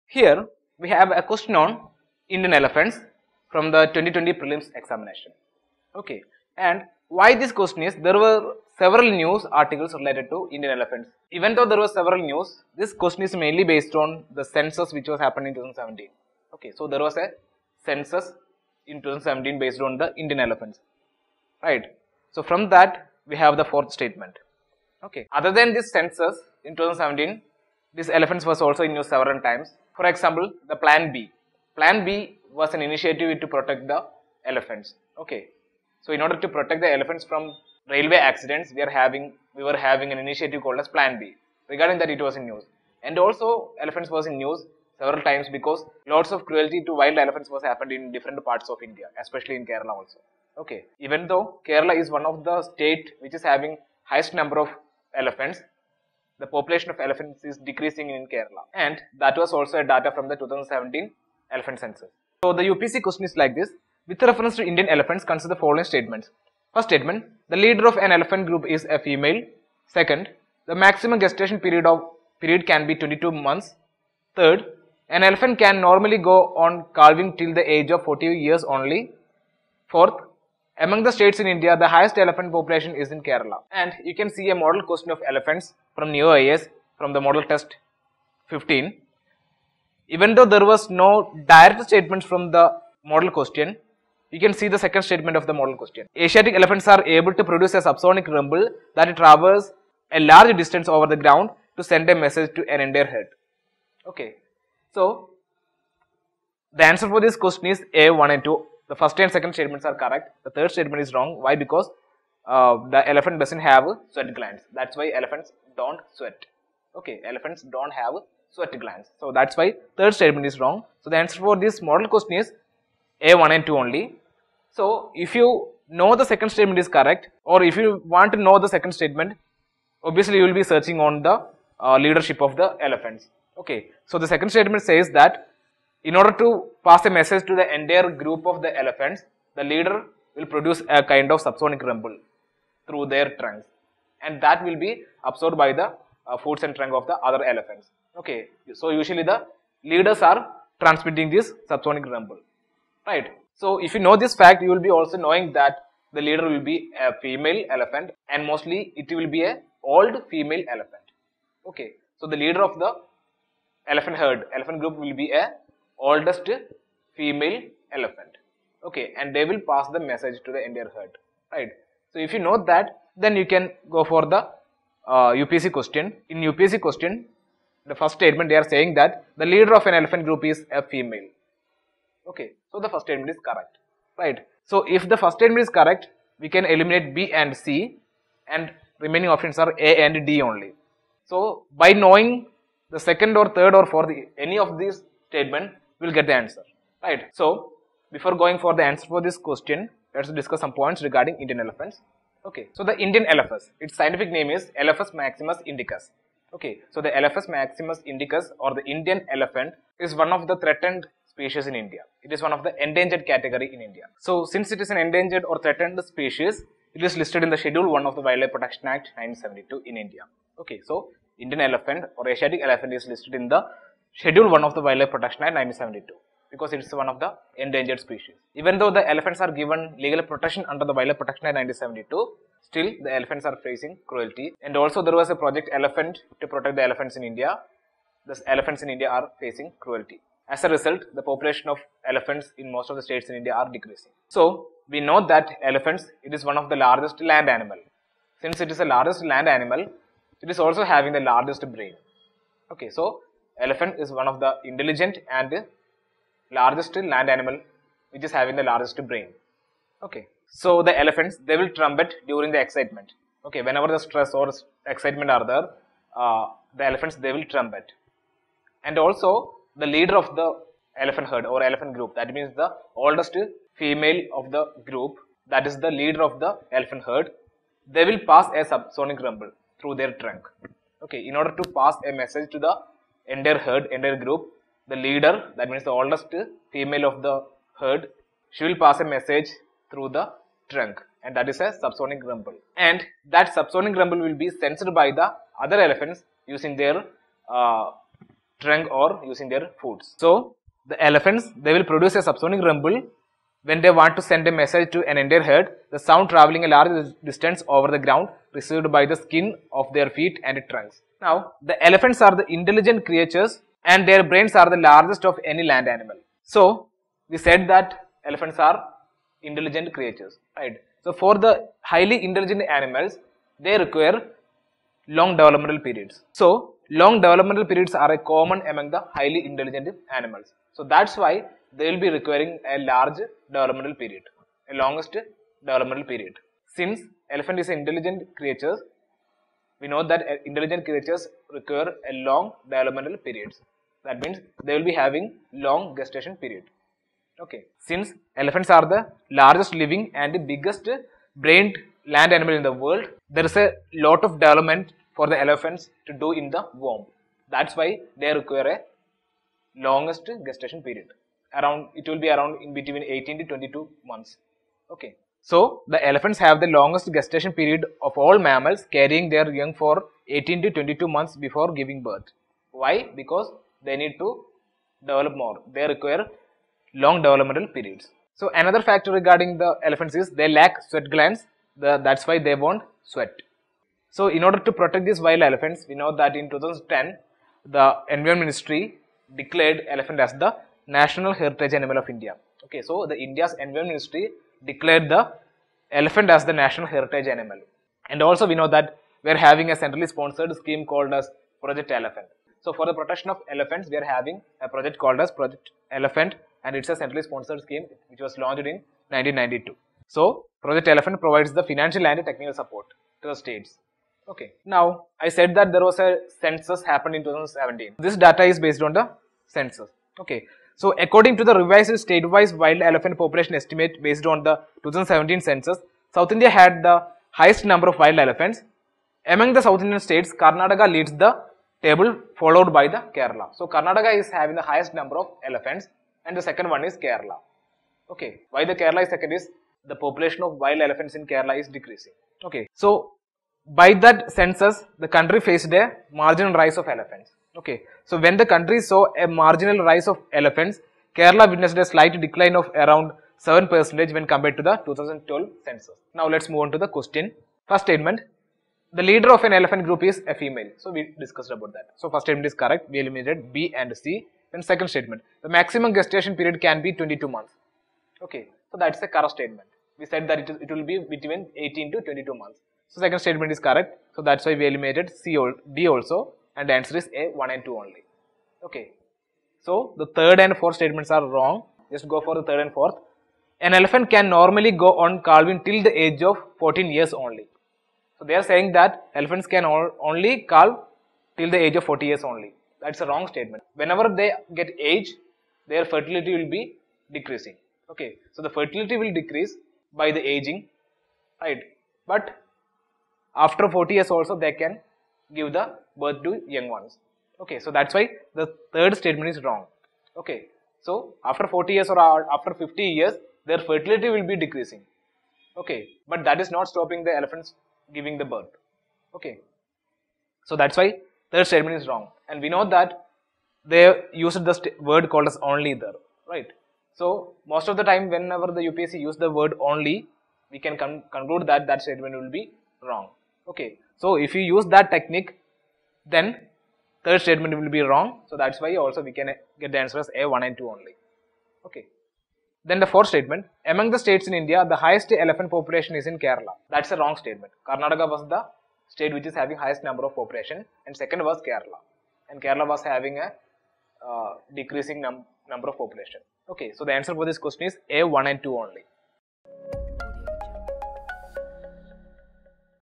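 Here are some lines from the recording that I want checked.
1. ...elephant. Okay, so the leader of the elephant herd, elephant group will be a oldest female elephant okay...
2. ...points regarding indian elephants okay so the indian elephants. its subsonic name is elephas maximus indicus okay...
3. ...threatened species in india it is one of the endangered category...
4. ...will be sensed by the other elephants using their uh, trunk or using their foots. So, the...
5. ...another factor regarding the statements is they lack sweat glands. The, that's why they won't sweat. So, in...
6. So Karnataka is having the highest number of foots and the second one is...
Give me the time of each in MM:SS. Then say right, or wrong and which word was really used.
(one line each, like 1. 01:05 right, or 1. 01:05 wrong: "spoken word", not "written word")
1. 02:40 right
2. 03:20 wrong: "scientific", not "subsonic"
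3. 03:30 right
4. 04:54 right
5. 06:18 wrong: "elephants", not "statements"
6. 07:13 wrong: "elephants", not "foots".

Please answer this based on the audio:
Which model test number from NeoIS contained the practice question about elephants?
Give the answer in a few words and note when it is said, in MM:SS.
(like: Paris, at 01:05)
15, at 01:27.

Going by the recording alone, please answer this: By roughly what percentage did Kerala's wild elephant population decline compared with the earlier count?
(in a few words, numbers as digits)
7%.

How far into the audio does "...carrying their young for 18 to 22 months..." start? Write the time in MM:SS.
06:08.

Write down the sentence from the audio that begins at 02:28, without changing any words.
Okay, so usually the leaders are transmitting this subsonic rumble, right?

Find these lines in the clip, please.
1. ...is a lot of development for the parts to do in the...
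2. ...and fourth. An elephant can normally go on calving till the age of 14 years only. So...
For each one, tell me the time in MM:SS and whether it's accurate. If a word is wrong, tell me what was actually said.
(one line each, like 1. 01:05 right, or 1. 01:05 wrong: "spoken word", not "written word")
1. 05:53 wrong: "elephants", not "parts"
2. 08:02 right.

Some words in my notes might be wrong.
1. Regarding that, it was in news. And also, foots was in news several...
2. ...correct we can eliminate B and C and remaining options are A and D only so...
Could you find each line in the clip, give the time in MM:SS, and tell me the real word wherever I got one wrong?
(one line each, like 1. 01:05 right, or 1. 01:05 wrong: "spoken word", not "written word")
1. 00:41 wrong: "elephants", not "foots"
2. 03:05 right.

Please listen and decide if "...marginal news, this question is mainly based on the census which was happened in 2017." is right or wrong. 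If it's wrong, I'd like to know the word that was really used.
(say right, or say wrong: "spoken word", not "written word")
wrong: "several", not "marginal".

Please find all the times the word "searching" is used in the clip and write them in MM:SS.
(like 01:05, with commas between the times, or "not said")
02:10.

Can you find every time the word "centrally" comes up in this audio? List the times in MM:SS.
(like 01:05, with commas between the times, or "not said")
06:39, 06:46.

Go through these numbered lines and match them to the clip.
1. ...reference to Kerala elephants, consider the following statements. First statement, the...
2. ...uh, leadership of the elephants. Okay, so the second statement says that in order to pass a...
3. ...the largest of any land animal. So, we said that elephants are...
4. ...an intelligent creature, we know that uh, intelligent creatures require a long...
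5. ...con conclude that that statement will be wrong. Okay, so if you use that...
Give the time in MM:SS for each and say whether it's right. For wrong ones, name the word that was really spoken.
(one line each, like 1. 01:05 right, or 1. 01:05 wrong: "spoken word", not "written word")
1. 01:04 wrong: "Indian", not "Kerala"
2. 02:11 right
3. 05:14 right
4. 05:37 right
5. 08:50 right.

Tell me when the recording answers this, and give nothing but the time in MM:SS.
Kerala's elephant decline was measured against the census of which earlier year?
07:34.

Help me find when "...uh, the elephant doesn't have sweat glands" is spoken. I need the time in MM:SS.
01:52.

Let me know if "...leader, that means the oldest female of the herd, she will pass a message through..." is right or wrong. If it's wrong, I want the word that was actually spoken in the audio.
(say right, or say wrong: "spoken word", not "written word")
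right.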